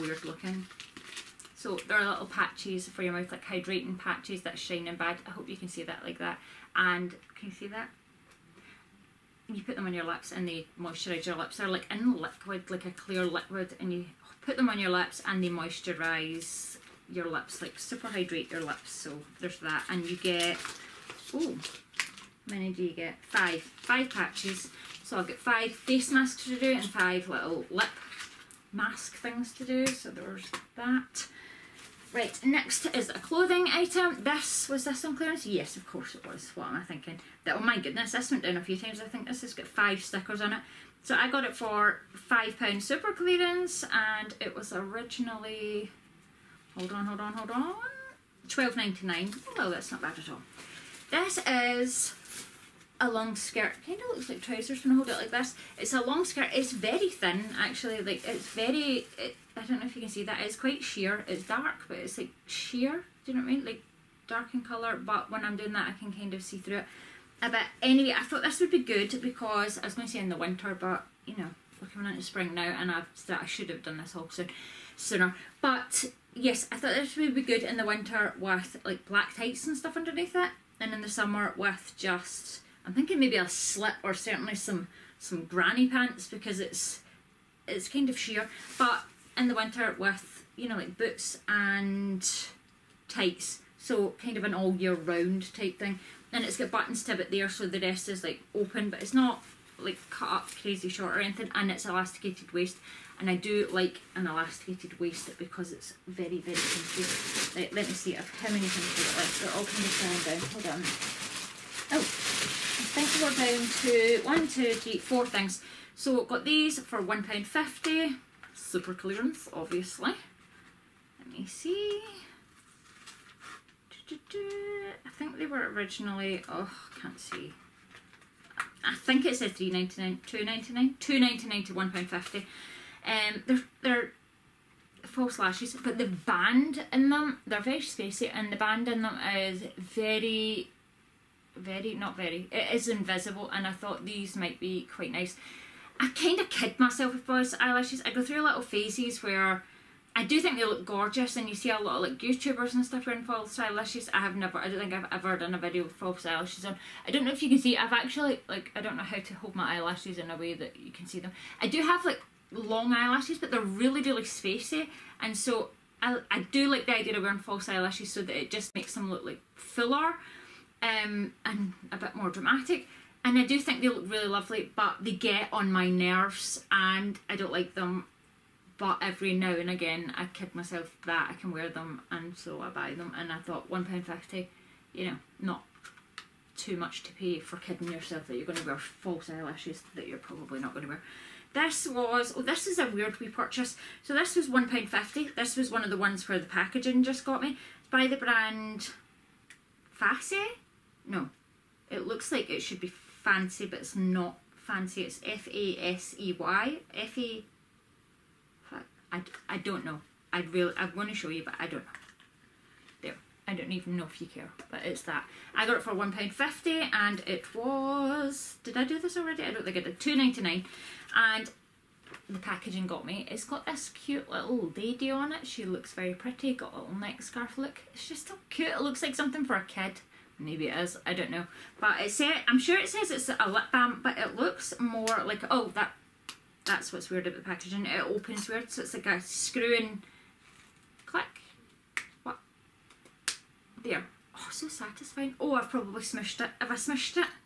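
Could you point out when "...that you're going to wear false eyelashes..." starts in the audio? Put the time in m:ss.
3:08.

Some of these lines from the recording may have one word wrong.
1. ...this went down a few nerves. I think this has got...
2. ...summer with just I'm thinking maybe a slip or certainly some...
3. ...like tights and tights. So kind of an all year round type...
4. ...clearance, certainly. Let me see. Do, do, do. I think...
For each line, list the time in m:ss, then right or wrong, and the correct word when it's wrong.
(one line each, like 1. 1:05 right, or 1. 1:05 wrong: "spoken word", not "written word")
1. 0:38 wrong: "times", not "nerves"
2. 1:21 right
3. 1:30 wrong: "boots", not "tights"
4. 1:58 wrong: "obviously", not "certainly".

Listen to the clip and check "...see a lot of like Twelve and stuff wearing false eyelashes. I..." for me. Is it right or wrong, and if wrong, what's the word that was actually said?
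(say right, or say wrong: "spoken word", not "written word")
wrong: "YouTubers", not "Twelve".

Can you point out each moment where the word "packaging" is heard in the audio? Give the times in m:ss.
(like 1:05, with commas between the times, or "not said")
3:16, 3:42, 3:57.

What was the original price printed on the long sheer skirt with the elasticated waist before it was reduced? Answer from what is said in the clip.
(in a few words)
£12.99.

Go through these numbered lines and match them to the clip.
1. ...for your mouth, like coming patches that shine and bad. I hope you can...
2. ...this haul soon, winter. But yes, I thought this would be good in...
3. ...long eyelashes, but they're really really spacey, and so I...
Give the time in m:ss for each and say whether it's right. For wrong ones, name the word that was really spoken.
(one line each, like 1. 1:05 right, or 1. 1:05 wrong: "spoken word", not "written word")
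1. 0:02 wrong: "hydrating", not "coming"
2. 1:13 wrong: "sooner", not "winter"
3. 2:42 right.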